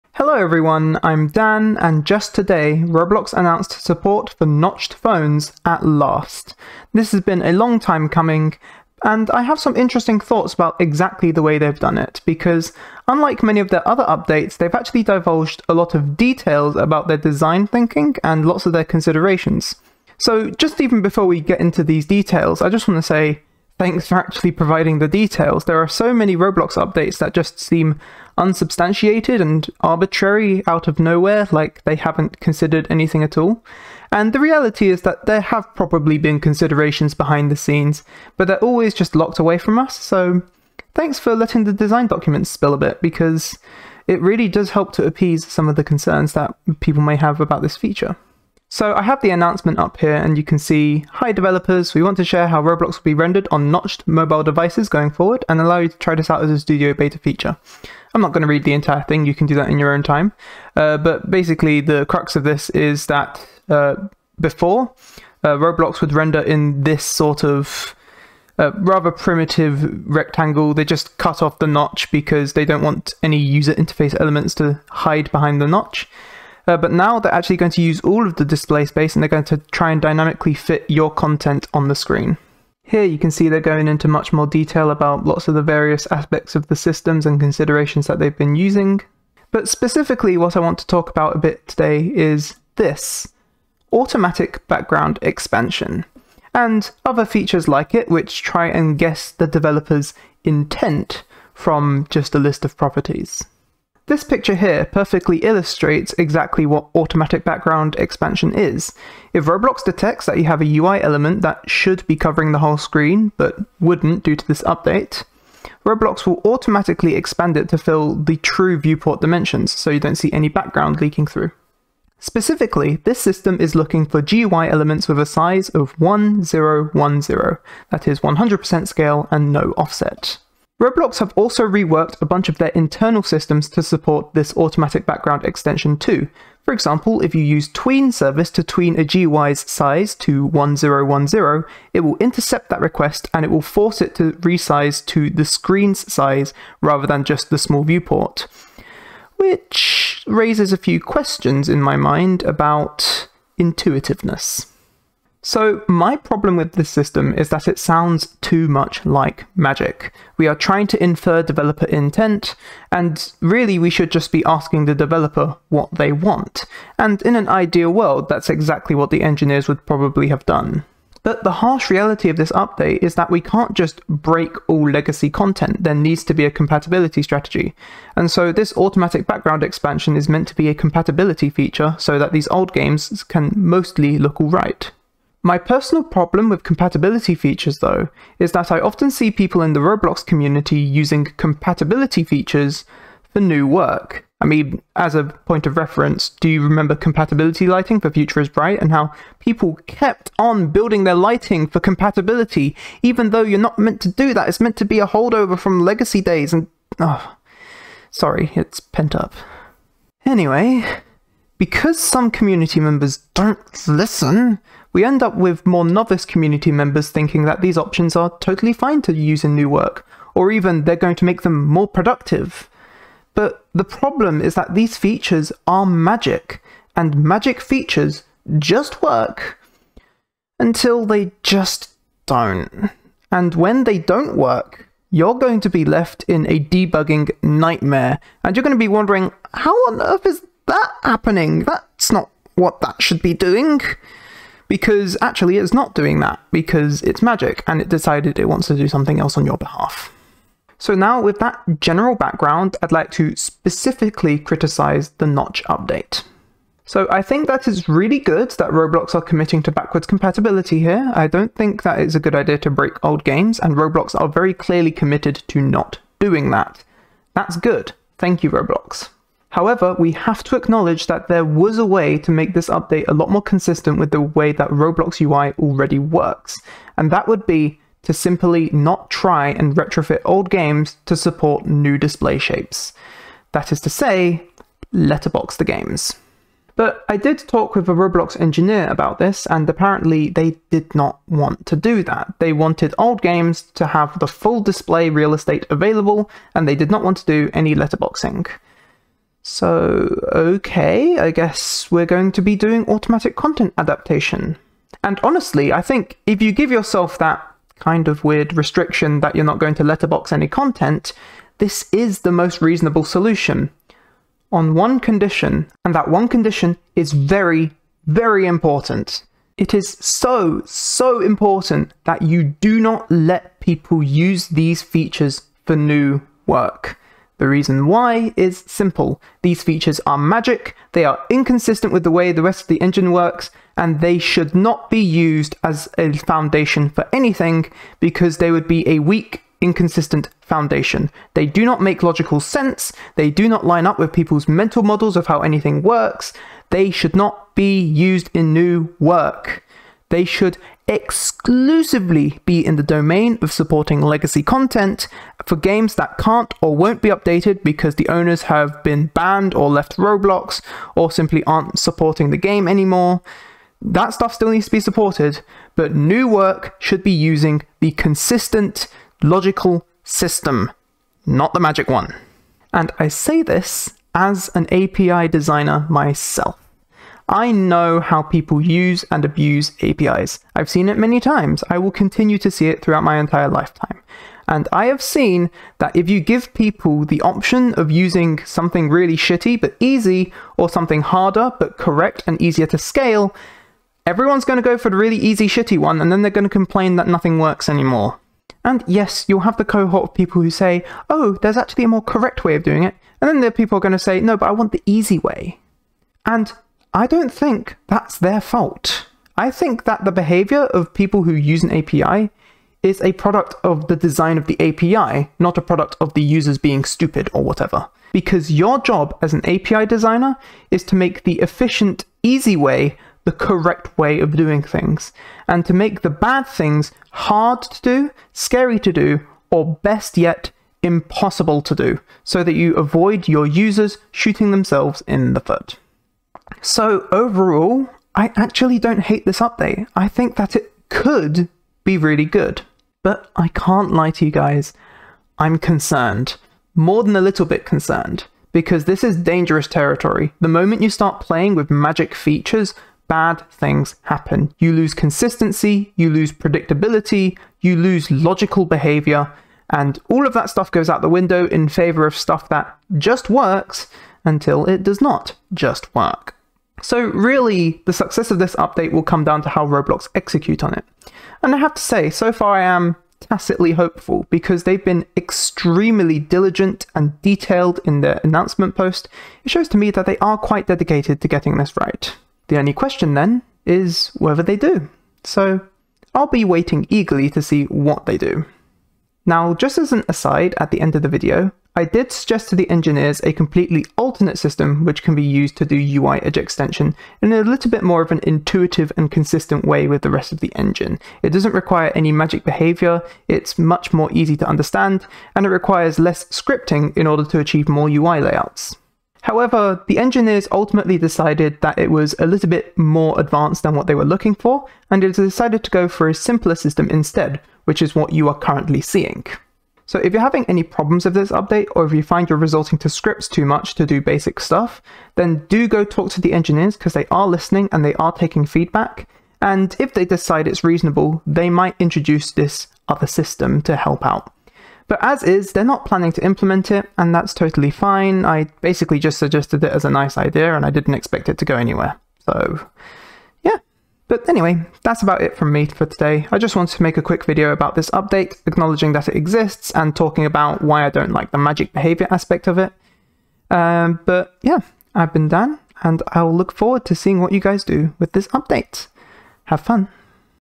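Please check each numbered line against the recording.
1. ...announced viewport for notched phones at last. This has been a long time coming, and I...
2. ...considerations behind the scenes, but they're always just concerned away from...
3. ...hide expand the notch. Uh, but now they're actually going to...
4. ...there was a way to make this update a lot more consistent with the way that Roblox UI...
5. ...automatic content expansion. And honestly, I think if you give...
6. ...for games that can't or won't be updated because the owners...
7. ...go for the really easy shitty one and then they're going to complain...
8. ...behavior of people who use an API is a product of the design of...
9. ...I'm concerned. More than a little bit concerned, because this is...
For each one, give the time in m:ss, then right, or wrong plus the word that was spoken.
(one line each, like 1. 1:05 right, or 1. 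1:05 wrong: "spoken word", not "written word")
1. 0:03 wrong: "support", not "viewport"
2. 0:36 wrong: "locked", not "concerned"
3. 1:14 wrong: "behind", not "expand"
4. 4:31 right
5. 5:02 wrong: "adaptation", not "expansion"
6. 5:55 right
7. 6:34 right
8. 6:50 right
9. 7:25 right.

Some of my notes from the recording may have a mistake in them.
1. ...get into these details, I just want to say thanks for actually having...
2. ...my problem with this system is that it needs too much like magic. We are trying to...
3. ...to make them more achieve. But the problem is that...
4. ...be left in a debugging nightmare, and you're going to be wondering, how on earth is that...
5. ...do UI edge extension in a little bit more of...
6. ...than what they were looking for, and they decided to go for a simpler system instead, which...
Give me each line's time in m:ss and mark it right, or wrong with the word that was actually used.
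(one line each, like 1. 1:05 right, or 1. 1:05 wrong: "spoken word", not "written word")
1. 0:21 wrong: "providing", not "having"
2. 2:35 wrong: "sounds", not "needs"
3. 3:41 wrong: "productive", not "achieve"
4. 3:55 right
5. 8:15 right
6. 8:33 right.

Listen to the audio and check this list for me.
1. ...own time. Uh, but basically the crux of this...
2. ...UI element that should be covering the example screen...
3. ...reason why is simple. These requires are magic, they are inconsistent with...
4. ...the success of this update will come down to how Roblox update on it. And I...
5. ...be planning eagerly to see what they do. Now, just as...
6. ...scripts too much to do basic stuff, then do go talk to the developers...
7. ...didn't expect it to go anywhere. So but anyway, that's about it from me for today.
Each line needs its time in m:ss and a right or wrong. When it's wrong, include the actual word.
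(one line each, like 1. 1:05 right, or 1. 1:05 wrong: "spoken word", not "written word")
1. 0:59 right
2. 1:50 wrong: "whole", not "example"
3. 5:27 wrong: "features", not "requires"
4. 7:47 wrong: "execute", not "update"
5. 8:06 wrong: "waiting", not "planning"
6. 8:42 wrong: "engineers", not "developers"
7. 9:00 right.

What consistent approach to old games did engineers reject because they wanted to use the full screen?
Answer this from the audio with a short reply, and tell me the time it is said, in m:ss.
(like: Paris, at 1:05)
letterbox the games, at 4:44.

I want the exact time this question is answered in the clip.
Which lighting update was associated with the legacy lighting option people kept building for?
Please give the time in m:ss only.
3:18.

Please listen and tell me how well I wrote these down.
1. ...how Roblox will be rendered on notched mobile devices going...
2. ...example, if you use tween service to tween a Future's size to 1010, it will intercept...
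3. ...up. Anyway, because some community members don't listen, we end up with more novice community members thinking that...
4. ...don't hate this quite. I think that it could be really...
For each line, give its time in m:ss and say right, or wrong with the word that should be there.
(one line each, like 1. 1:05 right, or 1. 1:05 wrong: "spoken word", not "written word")
1. 0:52 right
2. 2:16 wrong: "GUI", not "Future"
3. 3:29 right
4. 7:18 wrong: "update", not "quite".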